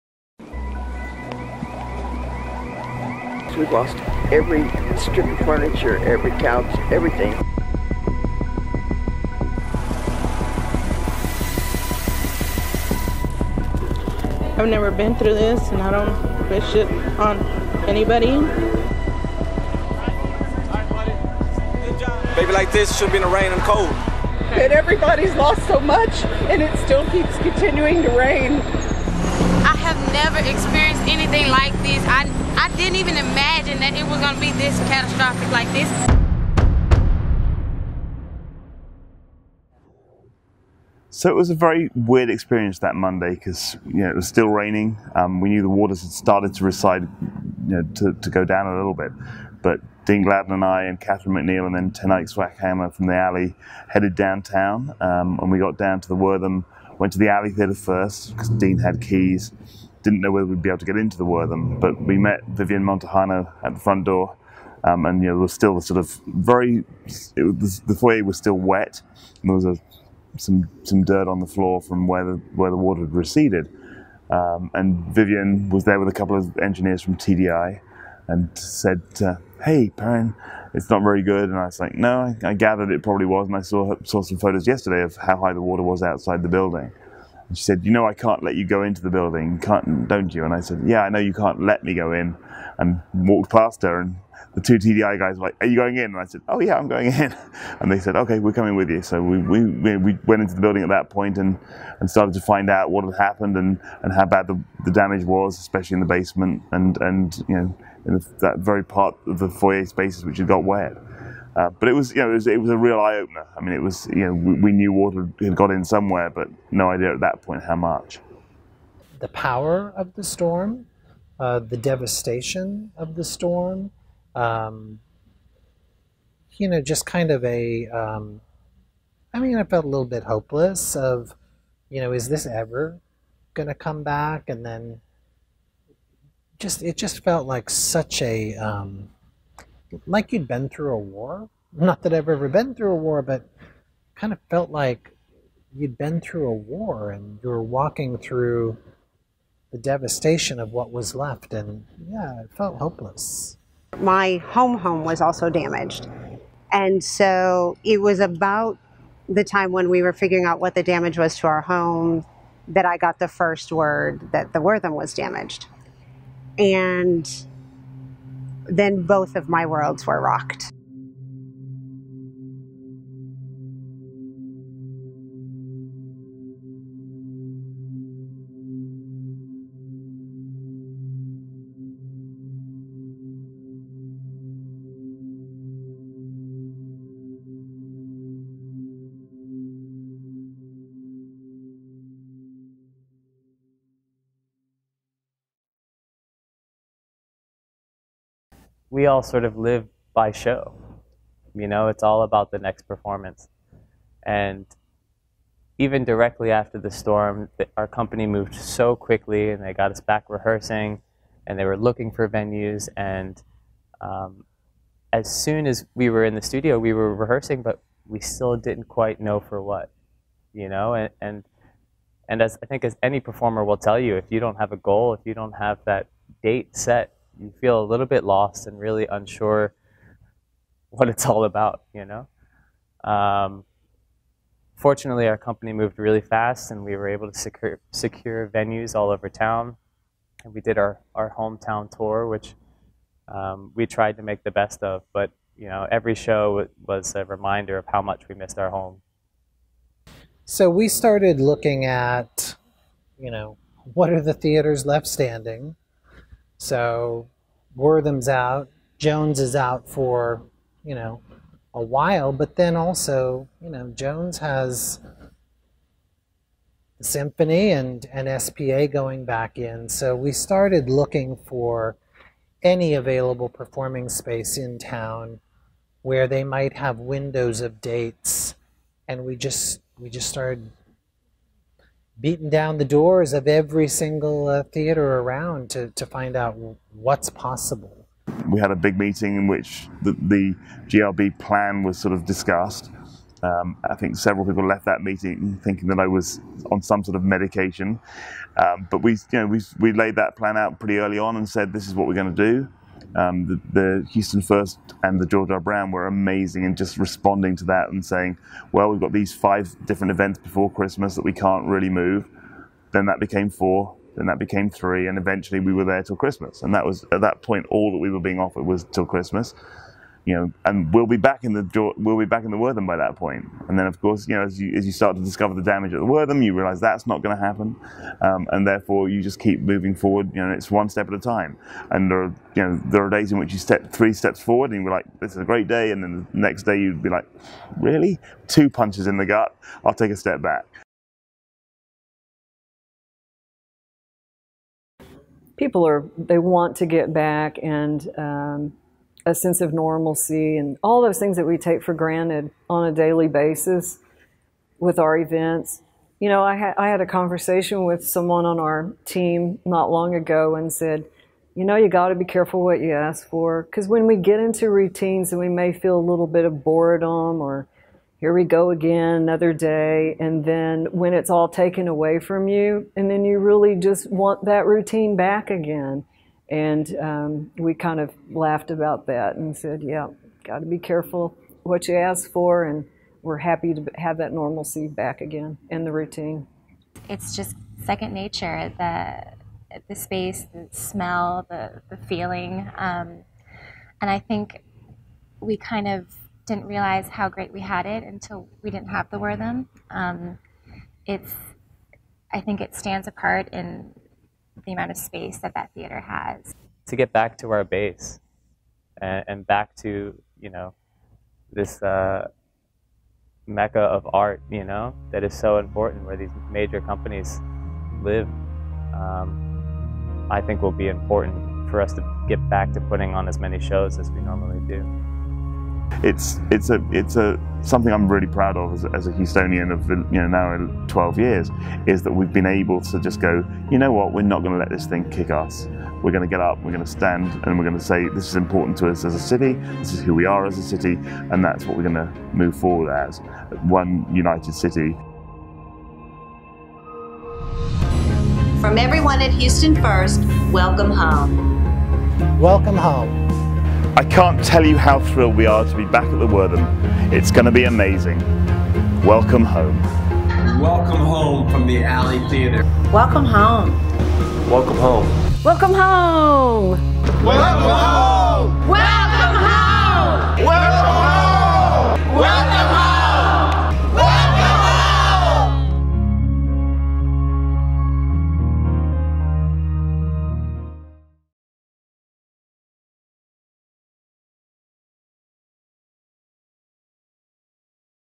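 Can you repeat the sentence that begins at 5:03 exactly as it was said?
Um, the, the, Houston First and the George R.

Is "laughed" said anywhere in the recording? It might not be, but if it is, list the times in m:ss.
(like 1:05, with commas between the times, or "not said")
6:18.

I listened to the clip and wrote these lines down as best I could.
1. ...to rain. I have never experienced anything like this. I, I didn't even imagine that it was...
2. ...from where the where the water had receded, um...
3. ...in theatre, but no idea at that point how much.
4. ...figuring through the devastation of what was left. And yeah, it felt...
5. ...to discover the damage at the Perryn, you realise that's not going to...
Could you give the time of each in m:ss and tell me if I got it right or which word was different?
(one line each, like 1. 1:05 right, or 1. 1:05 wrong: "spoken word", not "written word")
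1. 0:28 right
2. 1:11 right
3. 1:55 wrong: "somewhere", not "theatre"
4. 2:27 wrong: "walking", not "figuring"
5. 5:25 wrong: "Wortham", not "Perryn".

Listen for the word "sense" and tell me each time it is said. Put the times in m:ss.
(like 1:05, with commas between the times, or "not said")
5:49.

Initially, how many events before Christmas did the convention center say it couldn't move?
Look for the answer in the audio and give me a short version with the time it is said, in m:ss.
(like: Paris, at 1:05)
5, at 5:09.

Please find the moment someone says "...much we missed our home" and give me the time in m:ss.
4:08.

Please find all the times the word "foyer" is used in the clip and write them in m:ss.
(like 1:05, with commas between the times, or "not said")
1:07, 1:49.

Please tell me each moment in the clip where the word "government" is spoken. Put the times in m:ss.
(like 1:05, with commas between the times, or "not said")
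not said.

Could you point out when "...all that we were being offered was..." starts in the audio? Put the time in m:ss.
5:17.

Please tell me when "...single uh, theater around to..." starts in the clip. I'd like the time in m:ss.
4:43.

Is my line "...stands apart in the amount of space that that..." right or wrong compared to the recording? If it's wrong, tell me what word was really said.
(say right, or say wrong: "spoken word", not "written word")
right.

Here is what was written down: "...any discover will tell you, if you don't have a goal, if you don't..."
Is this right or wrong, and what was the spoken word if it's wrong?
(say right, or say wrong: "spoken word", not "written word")
wrong: "performer", not "discover".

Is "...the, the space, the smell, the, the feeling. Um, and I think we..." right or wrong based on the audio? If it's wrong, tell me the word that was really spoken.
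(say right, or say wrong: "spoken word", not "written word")
right.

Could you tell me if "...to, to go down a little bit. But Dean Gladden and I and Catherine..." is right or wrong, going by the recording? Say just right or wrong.
right.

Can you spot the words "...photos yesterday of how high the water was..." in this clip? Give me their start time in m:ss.
1:24.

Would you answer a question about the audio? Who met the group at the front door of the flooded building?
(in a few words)
Vivian Montejano.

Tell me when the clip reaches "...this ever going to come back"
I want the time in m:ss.
2:12.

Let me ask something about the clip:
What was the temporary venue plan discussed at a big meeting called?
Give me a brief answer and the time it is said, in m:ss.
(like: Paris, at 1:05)
GRB plan, at 4:50.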